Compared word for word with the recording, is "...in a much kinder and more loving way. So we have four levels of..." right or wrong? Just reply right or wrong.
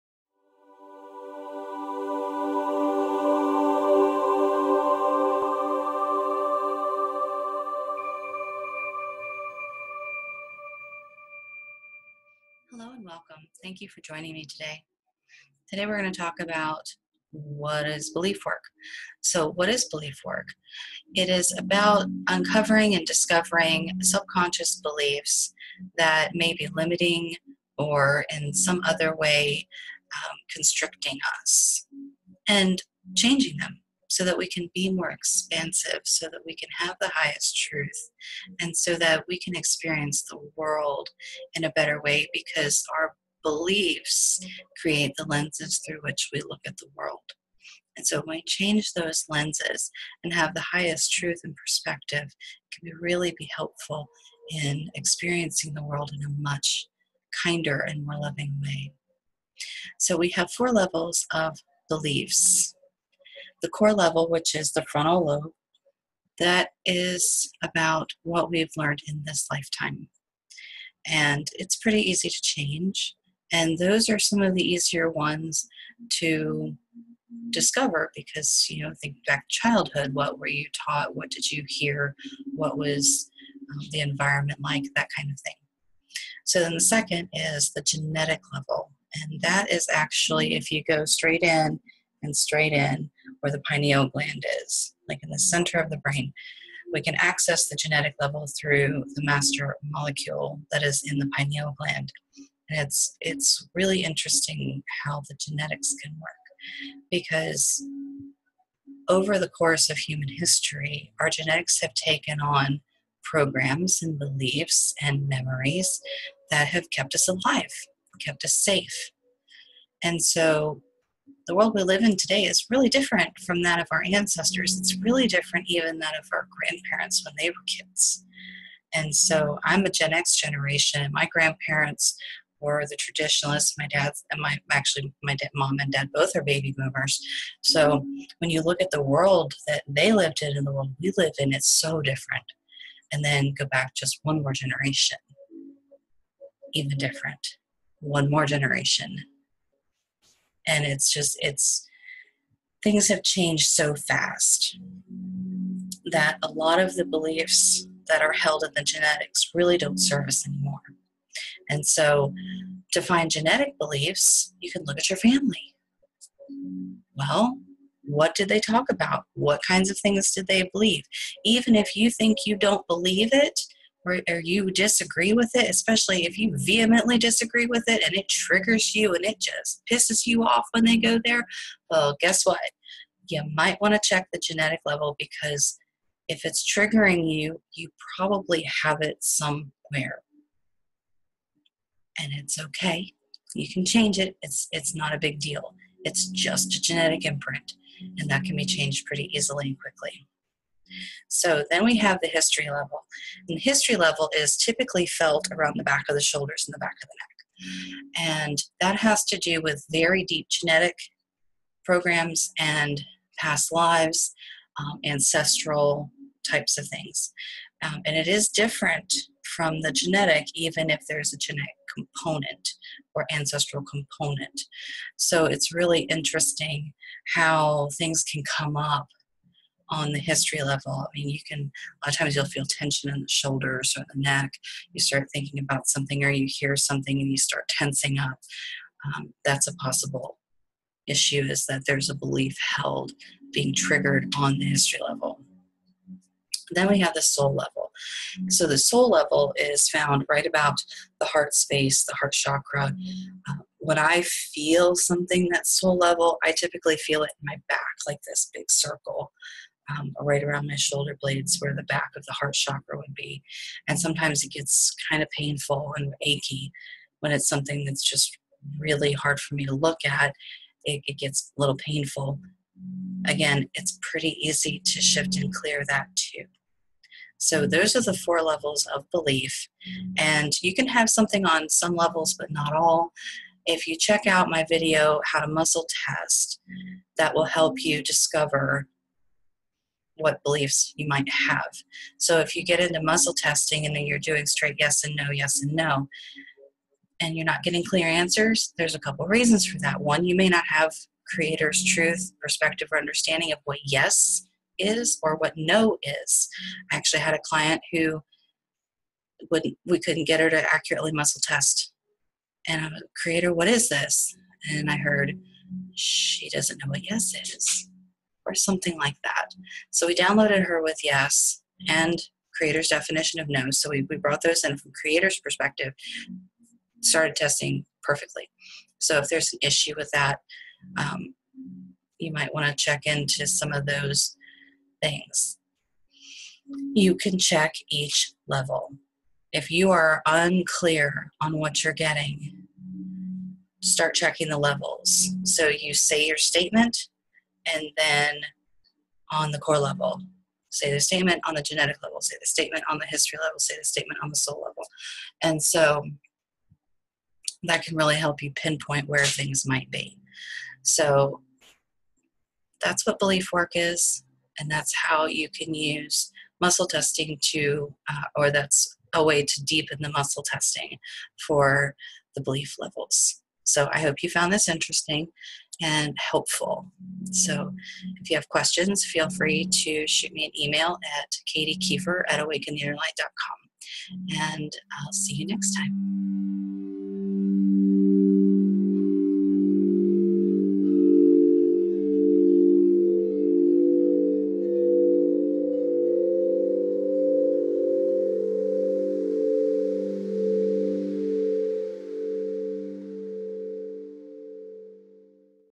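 right.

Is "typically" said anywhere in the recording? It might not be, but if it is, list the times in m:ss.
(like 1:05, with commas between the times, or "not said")
3:24, 4:16.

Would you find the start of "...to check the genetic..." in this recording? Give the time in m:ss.
3:03.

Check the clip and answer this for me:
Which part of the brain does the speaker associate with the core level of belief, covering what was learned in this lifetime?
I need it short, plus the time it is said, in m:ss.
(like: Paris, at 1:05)
Frontal lobe, at 1:04.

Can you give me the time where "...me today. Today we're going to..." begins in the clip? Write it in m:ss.
0:14.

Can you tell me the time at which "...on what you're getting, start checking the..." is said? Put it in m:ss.
5:41.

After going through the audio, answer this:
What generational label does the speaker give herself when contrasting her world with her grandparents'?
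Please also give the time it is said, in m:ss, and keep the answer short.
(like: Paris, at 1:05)
Gen X, at 2:09.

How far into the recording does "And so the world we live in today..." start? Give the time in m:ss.
2:00.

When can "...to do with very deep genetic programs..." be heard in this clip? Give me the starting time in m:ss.
3:29.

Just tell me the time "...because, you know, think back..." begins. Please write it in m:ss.
1:18.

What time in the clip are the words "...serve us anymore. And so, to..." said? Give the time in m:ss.
2:39.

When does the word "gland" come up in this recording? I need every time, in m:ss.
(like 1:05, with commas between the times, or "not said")
1:34, 1:41.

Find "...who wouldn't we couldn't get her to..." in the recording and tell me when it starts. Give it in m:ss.
5:07.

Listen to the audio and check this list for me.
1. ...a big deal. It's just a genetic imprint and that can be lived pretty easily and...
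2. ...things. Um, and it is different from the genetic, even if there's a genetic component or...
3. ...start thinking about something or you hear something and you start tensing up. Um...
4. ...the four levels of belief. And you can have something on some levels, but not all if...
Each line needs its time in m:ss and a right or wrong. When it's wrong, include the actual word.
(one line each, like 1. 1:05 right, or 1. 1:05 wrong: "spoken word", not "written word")
1. 3:15 wrong: "changed", not "lived"
2. 3:36 right
3. 3:55 right
4. 4:38 right.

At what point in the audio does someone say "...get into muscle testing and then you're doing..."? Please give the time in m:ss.
4:52.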